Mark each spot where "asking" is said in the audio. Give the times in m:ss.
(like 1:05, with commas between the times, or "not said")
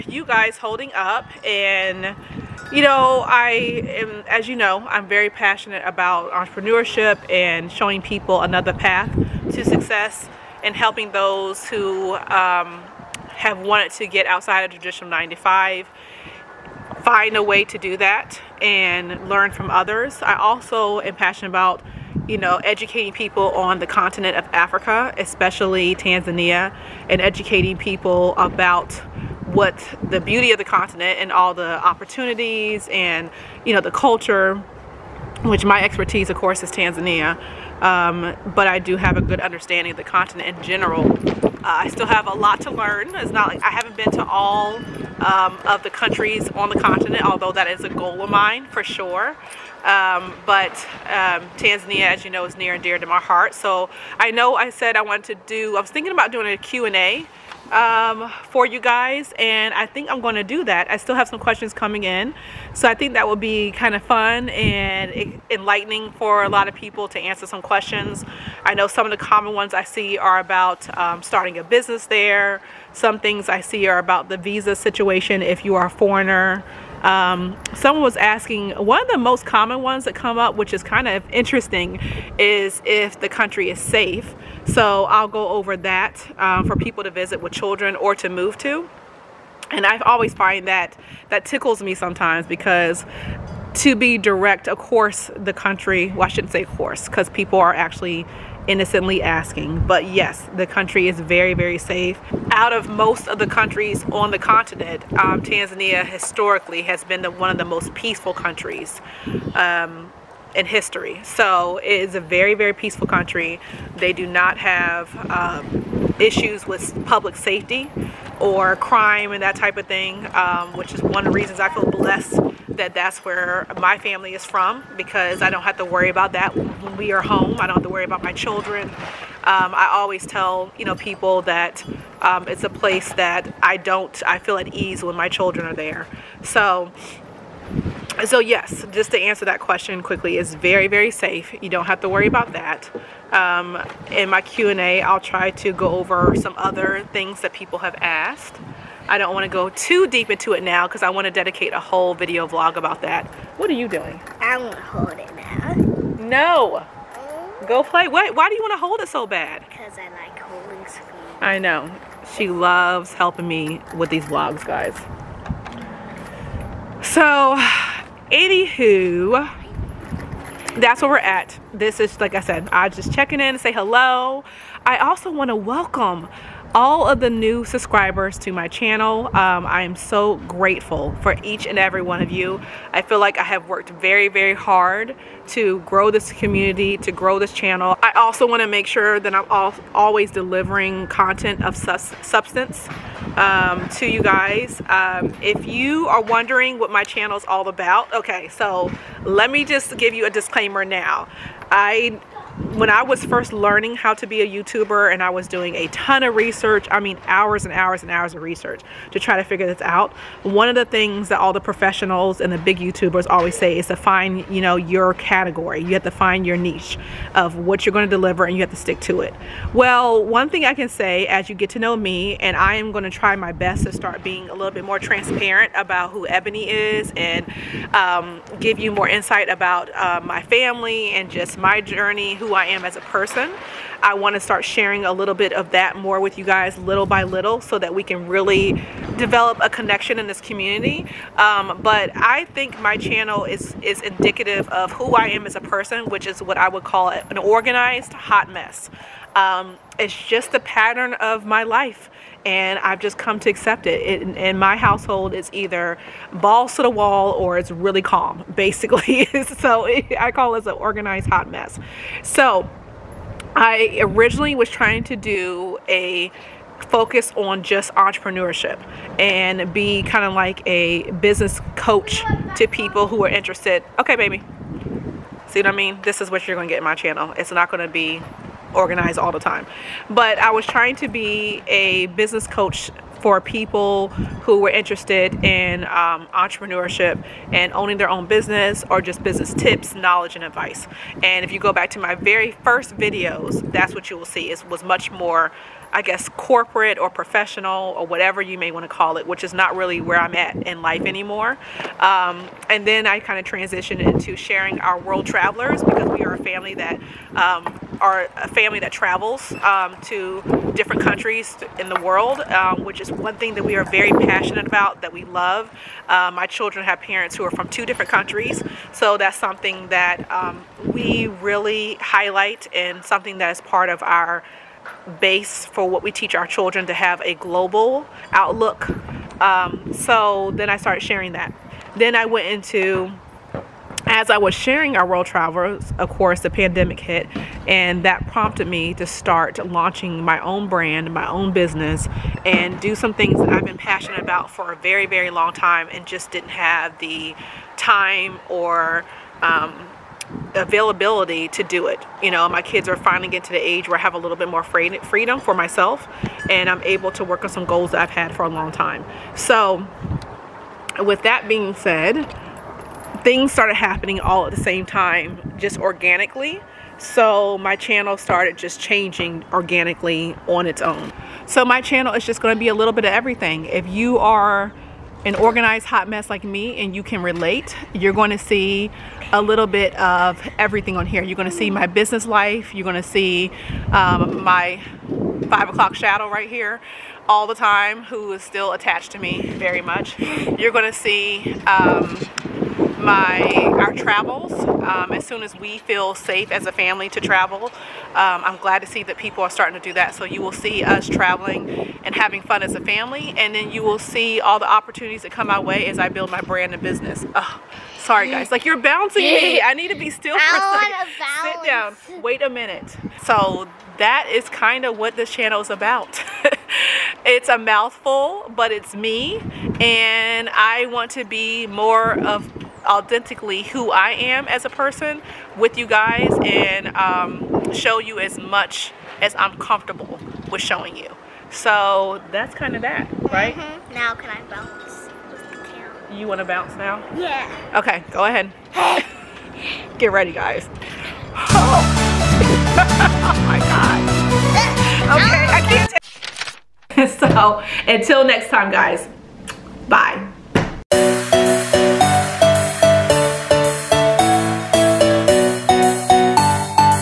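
1:18, 1:39.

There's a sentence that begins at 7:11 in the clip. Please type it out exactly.
So that's kind of that, right?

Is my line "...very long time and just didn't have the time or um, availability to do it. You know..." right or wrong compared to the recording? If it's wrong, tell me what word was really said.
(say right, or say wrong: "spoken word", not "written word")
right.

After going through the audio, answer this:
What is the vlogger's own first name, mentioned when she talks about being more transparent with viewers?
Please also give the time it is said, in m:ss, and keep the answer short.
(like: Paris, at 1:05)
Ebonie, at 3:46.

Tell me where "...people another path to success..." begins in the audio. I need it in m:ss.
0:08.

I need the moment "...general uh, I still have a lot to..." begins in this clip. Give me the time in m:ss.
0:40.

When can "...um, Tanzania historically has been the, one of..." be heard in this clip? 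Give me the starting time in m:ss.
1:45.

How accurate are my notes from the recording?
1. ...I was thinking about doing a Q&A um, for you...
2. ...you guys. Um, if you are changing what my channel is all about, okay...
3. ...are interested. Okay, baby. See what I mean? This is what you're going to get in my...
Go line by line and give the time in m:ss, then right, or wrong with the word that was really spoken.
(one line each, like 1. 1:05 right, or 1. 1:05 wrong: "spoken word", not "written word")
1. 0:55 right
2. 3:14 wrong: "wondering", not "changing"
3. 4:33 right.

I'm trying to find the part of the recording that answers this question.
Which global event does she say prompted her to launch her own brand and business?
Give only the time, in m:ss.
5:36.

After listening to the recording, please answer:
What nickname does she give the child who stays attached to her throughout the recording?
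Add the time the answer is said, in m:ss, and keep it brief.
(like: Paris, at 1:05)
five o'clock shadow, at 6:25.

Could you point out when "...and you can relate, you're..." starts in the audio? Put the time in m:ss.
6:16.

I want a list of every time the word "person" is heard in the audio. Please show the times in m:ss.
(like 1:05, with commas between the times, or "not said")
3:53, 4:05, 7:04.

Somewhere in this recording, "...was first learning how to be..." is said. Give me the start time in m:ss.
3:23.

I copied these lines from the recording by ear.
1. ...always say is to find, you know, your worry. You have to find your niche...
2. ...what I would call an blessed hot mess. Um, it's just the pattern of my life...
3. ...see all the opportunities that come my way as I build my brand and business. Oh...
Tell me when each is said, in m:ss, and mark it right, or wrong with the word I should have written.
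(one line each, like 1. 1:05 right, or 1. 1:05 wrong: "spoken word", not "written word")
1. 3:33 wrong: "category", not "worry"
2. 4:06 wrong: "organized", not "blessed"
3. 6:43 right.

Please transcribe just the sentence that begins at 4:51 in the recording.
And if you go back to my very first videos, that's what you will see.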